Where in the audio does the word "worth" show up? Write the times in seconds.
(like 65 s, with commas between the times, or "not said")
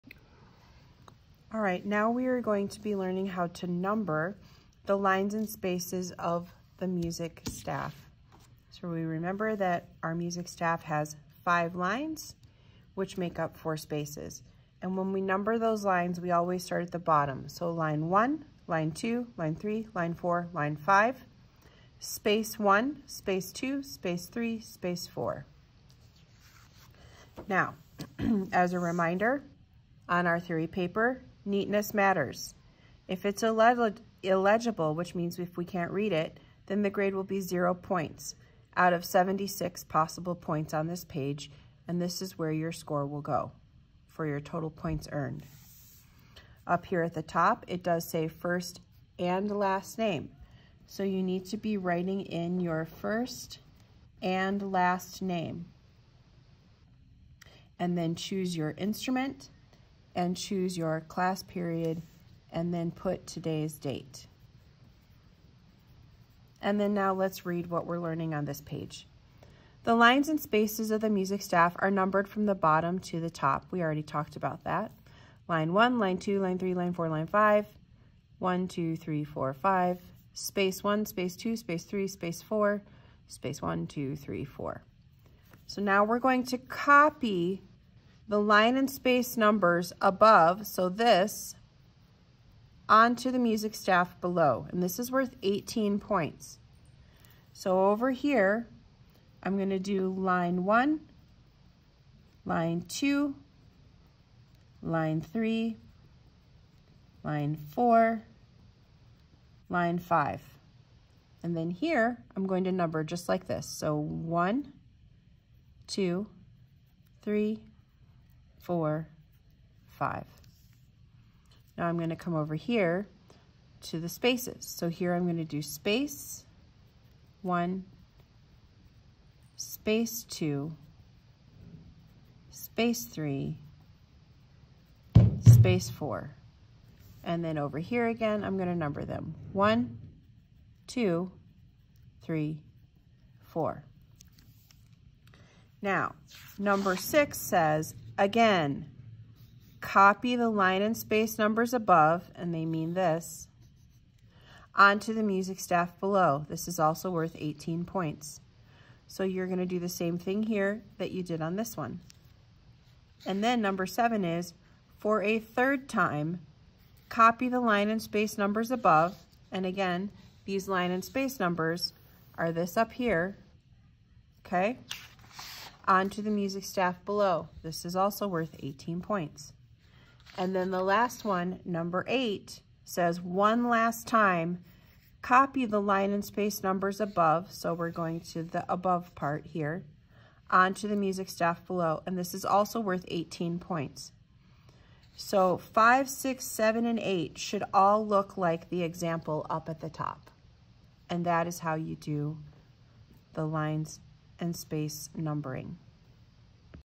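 95 s, 157 s, 178 s, 192 s.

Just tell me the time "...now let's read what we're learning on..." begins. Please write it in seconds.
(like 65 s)
66 s.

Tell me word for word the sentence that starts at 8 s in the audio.
So we remember that our music staff has five lines, which make up four spaces.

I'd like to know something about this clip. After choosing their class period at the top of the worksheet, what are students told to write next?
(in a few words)
today's date.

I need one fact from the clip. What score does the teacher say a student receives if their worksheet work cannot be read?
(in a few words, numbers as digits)
0 points.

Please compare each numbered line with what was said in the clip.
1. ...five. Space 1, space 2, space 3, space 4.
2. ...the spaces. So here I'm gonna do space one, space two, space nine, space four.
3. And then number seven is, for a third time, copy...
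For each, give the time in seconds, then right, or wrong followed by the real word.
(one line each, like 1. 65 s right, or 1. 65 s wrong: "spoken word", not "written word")
1. 79 s right
2. 123 s wrong: "three", not "nine"
3. 163 s right.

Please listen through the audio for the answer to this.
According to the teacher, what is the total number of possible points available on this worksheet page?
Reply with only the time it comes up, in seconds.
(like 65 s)
39 s.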